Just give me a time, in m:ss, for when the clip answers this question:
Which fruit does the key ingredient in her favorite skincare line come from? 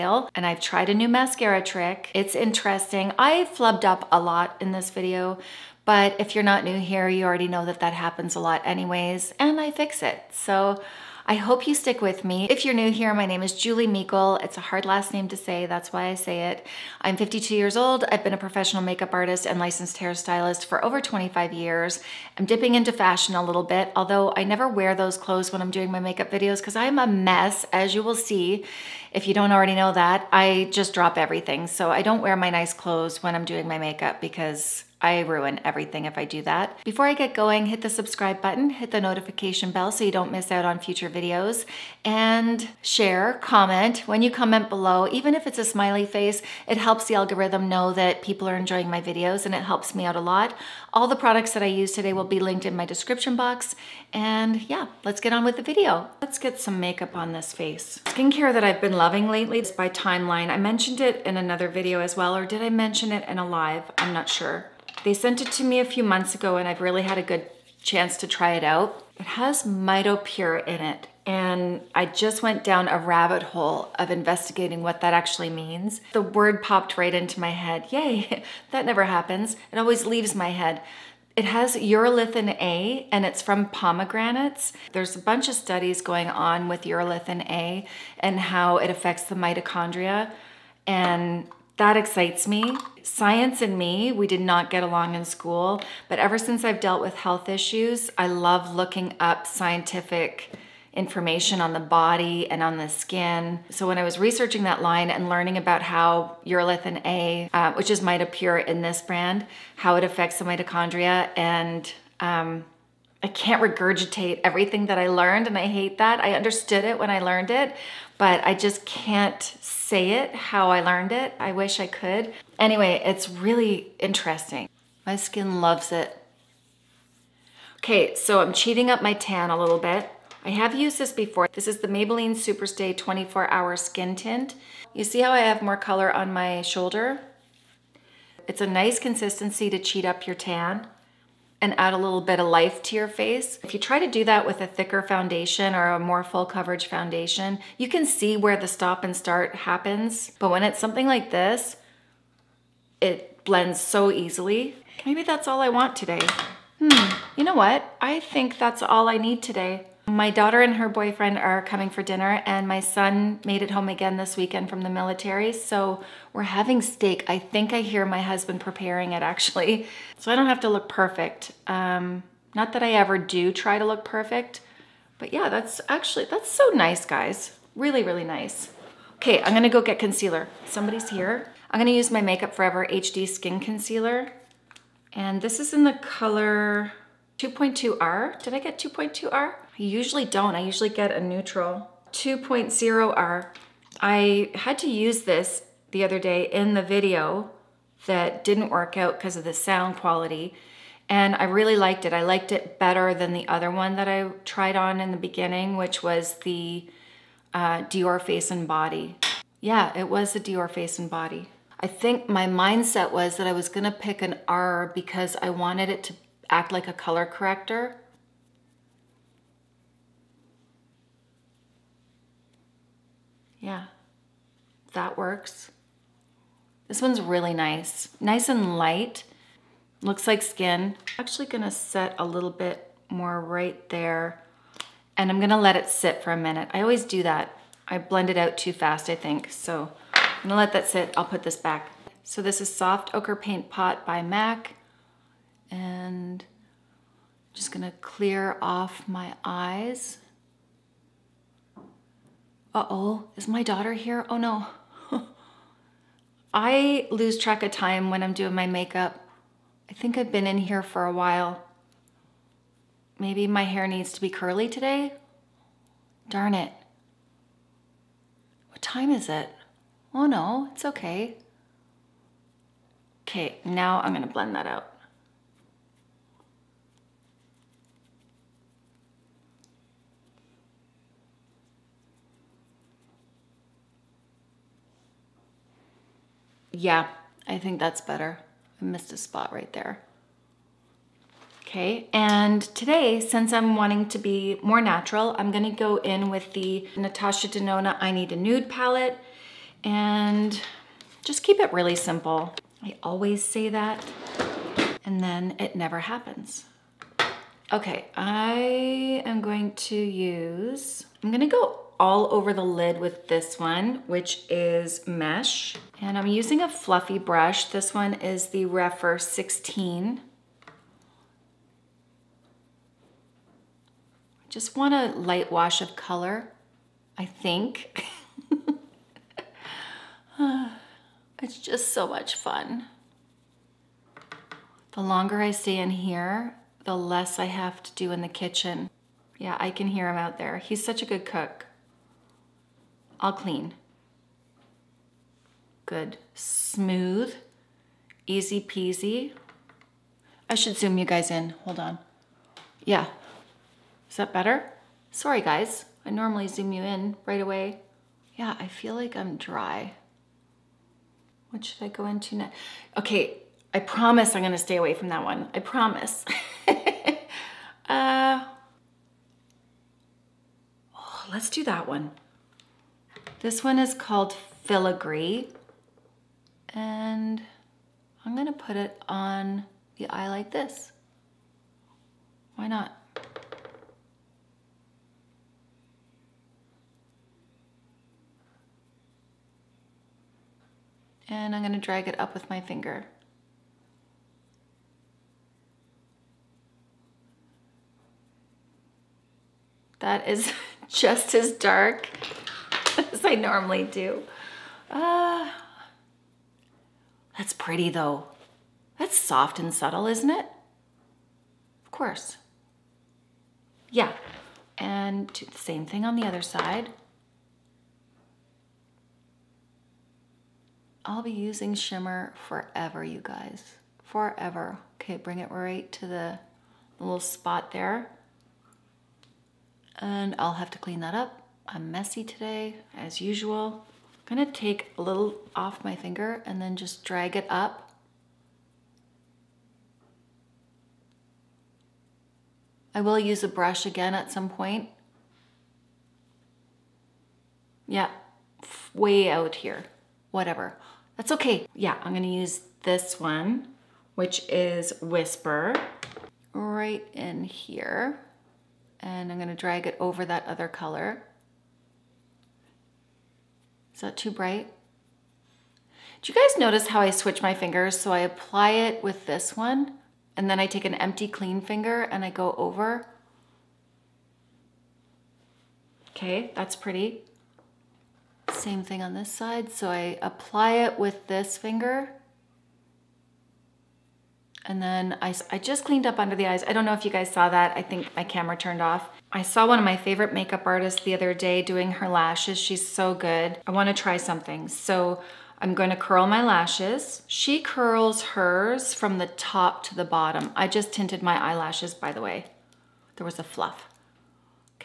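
1:23.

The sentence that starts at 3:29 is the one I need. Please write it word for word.
Yeah, it was the Dior Face and Body.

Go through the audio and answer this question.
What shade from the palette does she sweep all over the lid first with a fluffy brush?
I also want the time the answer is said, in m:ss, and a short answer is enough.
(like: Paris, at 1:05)
Mesh, at 5:15.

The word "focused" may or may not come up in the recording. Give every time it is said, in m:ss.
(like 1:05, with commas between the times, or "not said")
not said.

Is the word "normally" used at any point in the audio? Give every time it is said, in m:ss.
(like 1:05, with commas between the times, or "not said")
5:56, 6:43.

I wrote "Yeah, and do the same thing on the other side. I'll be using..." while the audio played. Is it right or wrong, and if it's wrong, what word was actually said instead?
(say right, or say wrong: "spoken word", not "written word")
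right.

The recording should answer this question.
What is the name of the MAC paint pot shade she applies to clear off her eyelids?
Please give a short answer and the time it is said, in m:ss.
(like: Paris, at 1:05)
Soft Ochre, at 4:02.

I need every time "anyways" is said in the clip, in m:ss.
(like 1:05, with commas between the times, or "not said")
0:08, 2:02.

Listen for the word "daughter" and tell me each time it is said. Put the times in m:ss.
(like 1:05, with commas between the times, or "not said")
2:40, 4:13.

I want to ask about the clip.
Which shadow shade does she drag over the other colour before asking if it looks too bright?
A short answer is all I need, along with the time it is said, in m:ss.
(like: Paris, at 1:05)
Whisper, at 7:35.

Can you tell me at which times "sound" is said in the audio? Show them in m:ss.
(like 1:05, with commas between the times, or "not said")
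3:19.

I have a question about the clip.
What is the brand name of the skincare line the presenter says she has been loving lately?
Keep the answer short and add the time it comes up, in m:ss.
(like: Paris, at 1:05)
Timeline, at 0:59.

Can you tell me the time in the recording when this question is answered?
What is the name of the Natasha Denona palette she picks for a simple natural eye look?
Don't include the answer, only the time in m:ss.
4:58.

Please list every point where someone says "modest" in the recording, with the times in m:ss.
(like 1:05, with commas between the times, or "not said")
not said.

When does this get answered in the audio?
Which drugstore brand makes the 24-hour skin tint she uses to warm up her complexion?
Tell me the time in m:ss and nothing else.
2:11.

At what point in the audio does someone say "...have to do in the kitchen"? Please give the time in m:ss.
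5:37.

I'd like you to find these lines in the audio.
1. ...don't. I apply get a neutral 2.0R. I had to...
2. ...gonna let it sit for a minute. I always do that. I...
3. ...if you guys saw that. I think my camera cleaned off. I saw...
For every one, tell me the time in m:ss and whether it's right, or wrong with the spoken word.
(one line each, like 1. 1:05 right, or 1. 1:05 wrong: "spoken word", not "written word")
1. 3:10 wrong: "usually", not "apply"
2. 3:55 right
3. 8:06 wrong: "turned", not "cleaned".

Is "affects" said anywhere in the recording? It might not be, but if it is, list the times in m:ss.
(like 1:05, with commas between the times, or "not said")
1:28, 1:50.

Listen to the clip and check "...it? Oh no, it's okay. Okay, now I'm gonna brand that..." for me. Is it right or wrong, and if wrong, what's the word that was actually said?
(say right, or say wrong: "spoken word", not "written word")
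wrong: "blend", not "brand".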